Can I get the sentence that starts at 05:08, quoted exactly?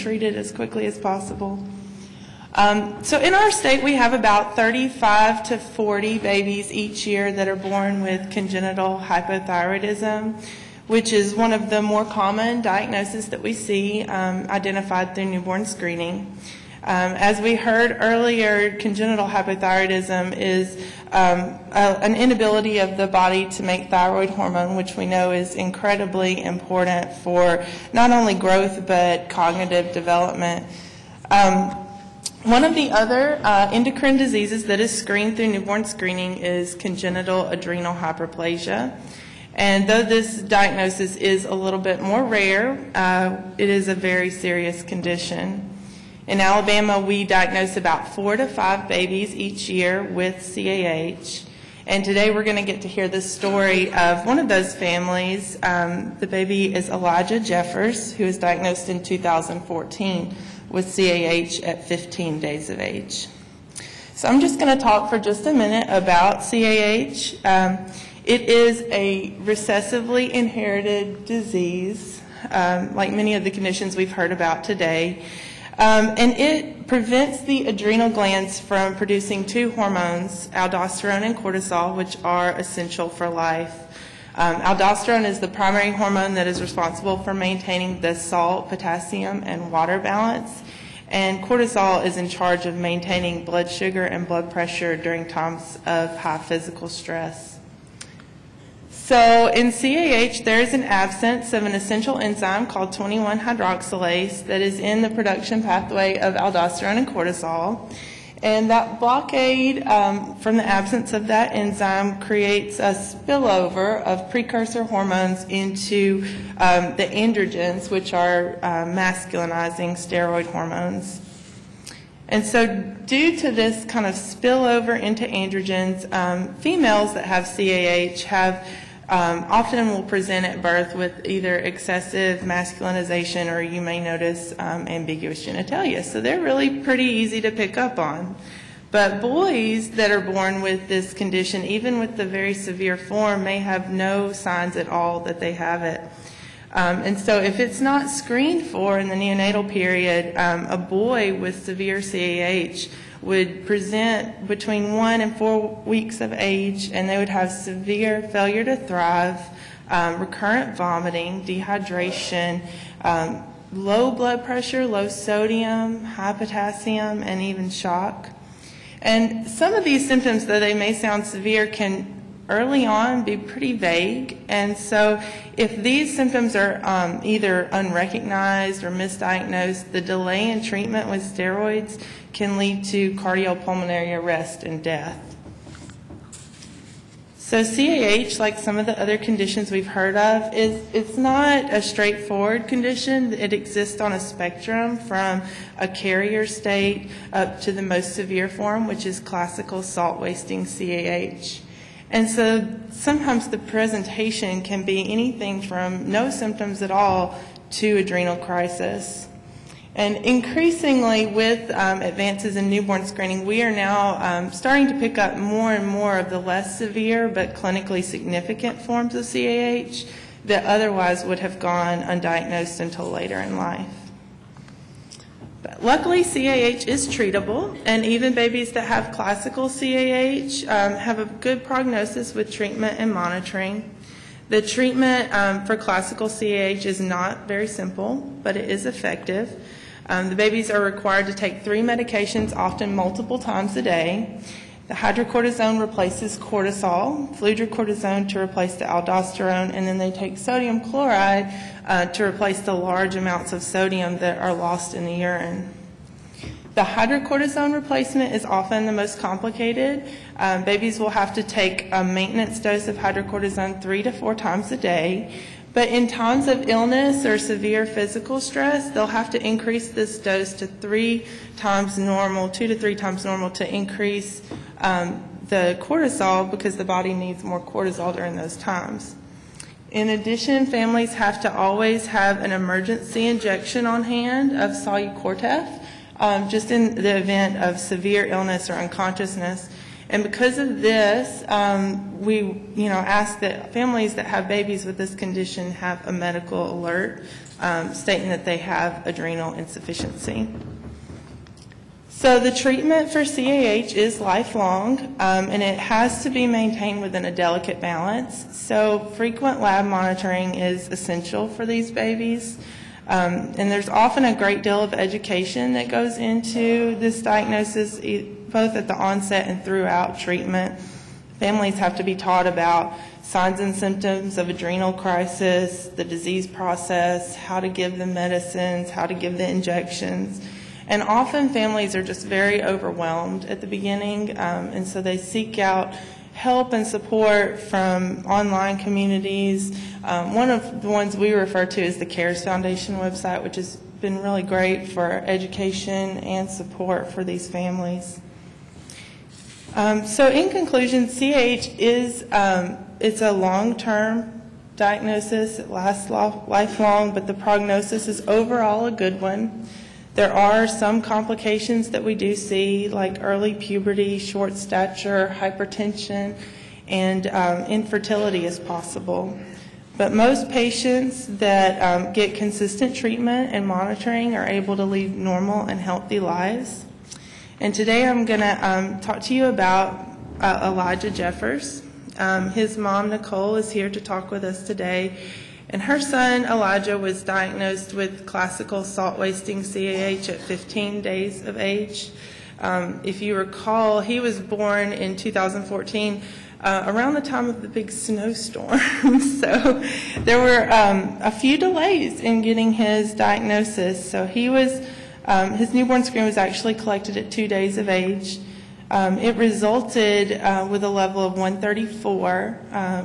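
So frequent lab monitoring is essential for these babies.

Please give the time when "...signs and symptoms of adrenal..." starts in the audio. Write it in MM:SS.
05:23.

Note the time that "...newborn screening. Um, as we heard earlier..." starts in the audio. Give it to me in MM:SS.
00:15.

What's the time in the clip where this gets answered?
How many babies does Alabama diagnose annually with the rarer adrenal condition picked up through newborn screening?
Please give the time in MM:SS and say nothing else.
00:48.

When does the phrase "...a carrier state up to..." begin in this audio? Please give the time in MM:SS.
03:15.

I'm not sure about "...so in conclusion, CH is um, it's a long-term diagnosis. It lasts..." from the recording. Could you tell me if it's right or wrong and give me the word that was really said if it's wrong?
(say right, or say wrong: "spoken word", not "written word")
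right.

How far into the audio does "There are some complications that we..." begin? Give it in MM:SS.
06:00.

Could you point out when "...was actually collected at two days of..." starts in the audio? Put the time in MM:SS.
06:46.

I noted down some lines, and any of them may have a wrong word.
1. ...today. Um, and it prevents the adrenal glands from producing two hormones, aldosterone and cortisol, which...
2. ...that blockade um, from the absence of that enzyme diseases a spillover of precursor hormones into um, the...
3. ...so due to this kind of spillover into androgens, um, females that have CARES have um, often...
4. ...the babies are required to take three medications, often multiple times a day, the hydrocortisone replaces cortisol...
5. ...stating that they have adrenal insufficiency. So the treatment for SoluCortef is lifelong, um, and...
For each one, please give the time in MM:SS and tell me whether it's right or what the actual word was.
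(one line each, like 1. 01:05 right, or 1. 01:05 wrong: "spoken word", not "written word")
1. 01:14 right
2. 01:48 wrong: "creates", not "diseases"
3. 02:02 wrong: "CAH", not "CARES"
4. 04:00 right
5. 04:57 wrong: "CAH", not "SoluCortef".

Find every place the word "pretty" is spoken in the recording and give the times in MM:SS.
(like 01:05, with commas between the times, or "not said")
02:16, 02:53.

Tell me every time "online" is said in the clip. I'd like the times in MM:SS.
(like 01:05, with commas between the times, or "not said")
05:38.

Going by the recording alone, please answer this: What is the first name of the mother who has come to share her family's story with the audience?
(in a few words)
Nicole.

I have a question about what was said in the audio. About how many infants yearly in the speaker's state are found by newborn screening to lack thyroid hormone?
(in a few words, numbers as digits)
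35 to 40.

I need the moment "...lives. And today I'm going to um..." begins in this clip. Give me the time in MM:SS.
06:16.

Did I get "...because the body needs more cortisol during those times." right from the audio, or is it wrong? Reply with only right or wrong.
right.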